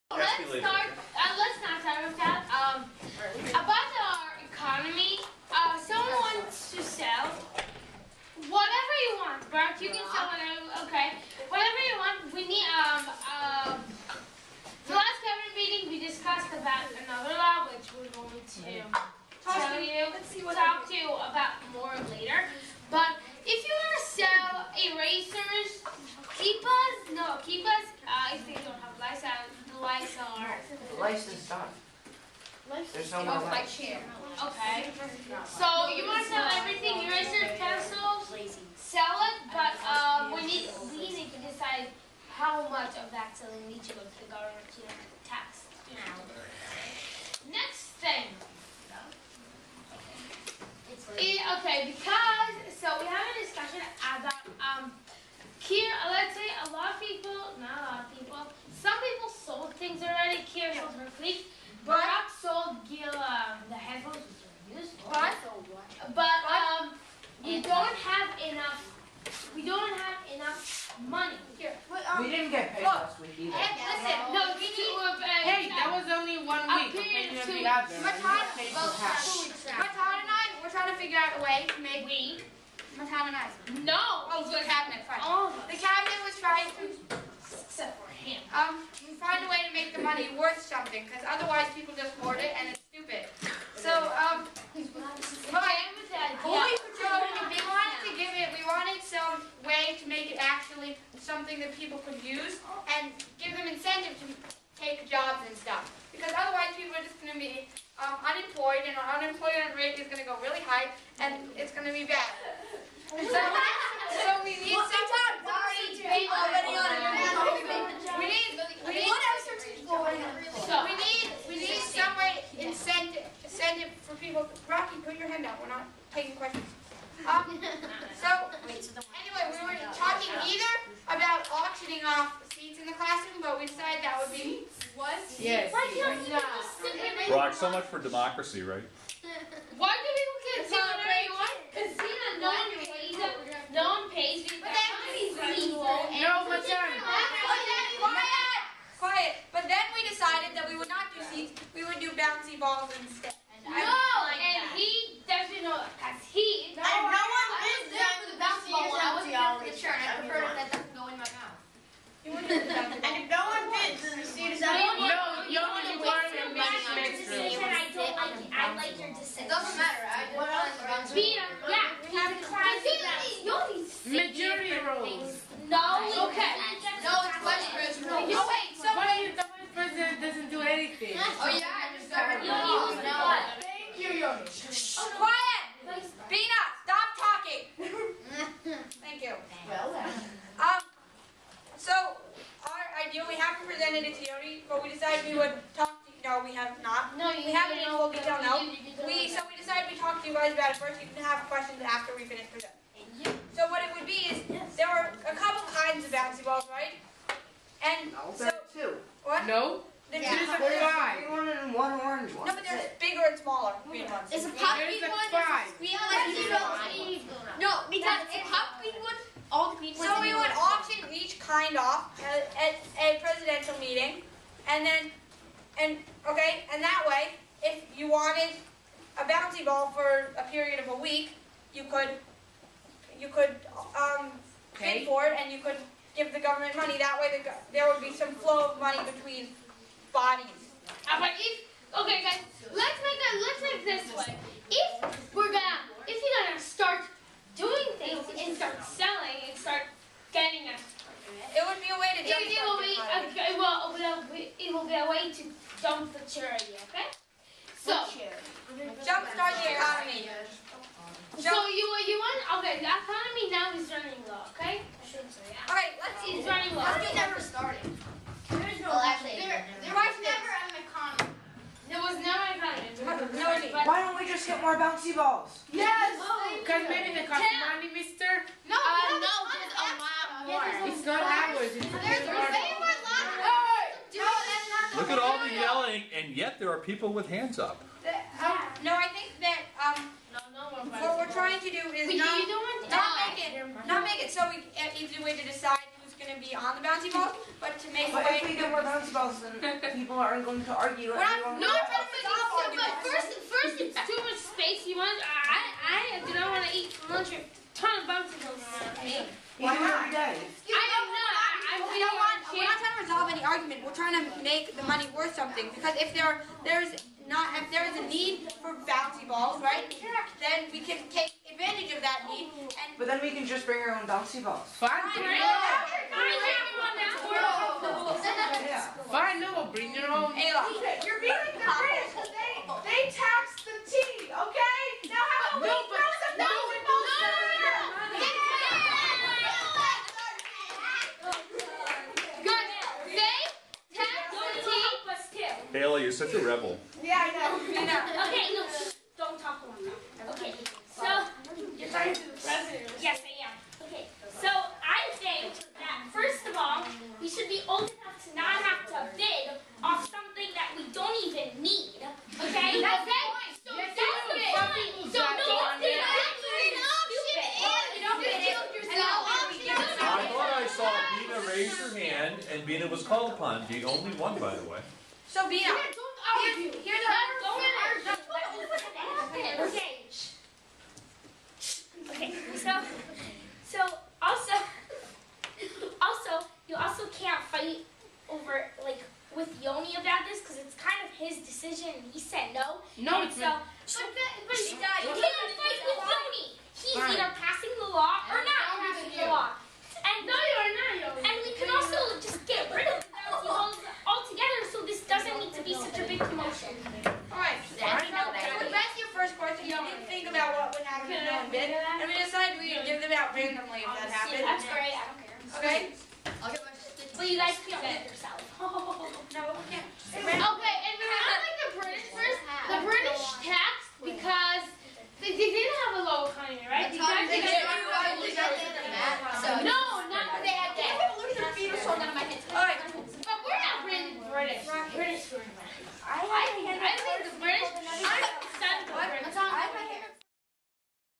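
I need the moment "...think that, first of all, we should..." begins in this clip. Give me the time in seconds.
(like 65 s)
355 s.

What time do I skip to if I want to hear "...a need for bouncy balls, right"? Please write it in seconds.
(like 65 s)
318 s.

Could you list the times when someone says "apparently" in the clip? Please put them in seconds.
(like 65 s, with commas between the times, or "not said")
not said.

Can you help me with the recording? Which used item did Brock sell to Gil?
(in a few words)
Headphones.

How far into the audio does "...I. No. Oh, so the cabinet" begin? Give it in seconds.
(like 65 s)
83 s.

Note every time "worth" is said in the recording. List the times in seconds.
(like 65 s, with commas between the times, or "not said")
90 s, 315 s.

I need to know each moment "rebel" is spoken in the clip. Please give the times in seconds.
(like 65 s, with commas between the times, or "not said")
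346 s.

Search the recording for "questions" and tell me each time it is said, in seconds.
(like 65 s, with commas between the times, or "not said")
126 s, 177 s, 201 s.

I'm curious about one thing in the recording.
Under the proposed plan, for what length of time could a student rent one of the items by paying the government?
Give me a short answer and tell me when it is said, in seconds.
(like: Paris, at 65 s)
A week, at 230 s.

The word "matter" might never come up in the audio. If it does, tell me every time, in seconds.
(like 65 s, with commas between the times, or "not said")
169 s.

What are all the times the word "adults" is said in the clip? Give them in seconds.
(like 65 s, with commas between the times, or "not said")
not said.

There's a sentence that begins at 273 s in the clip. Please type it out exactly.
Why don't we just get more bouncy balls?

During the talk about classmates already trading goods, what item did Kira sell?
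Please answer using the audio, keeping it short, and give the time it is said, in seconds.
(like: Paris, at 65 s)
Fleece, at 61 s.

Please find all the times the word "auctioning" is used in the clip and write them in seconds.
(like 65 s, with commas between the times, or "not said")
131 s.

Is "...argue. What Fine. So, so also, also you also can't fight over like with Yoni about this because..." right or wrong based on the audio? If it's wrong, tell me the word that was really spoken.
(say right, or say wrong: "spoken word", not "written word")
wrong: "Okay", not "Fine".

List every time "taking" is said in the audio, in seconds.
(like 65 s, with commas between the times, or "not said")
126 s.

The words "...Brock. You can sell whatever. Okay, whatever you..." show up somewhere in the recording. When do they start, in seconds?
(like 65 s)
9 s.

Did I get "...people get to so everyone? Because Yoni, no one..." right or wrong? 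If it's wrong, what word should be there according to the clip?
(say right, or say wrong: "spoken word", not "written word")
wrong: "Zena", not "Yoni".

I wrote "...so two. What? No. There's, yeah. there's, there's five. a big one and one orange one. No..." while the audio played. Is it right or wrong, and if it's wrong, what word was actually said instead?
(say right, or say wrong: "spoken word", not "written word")
right.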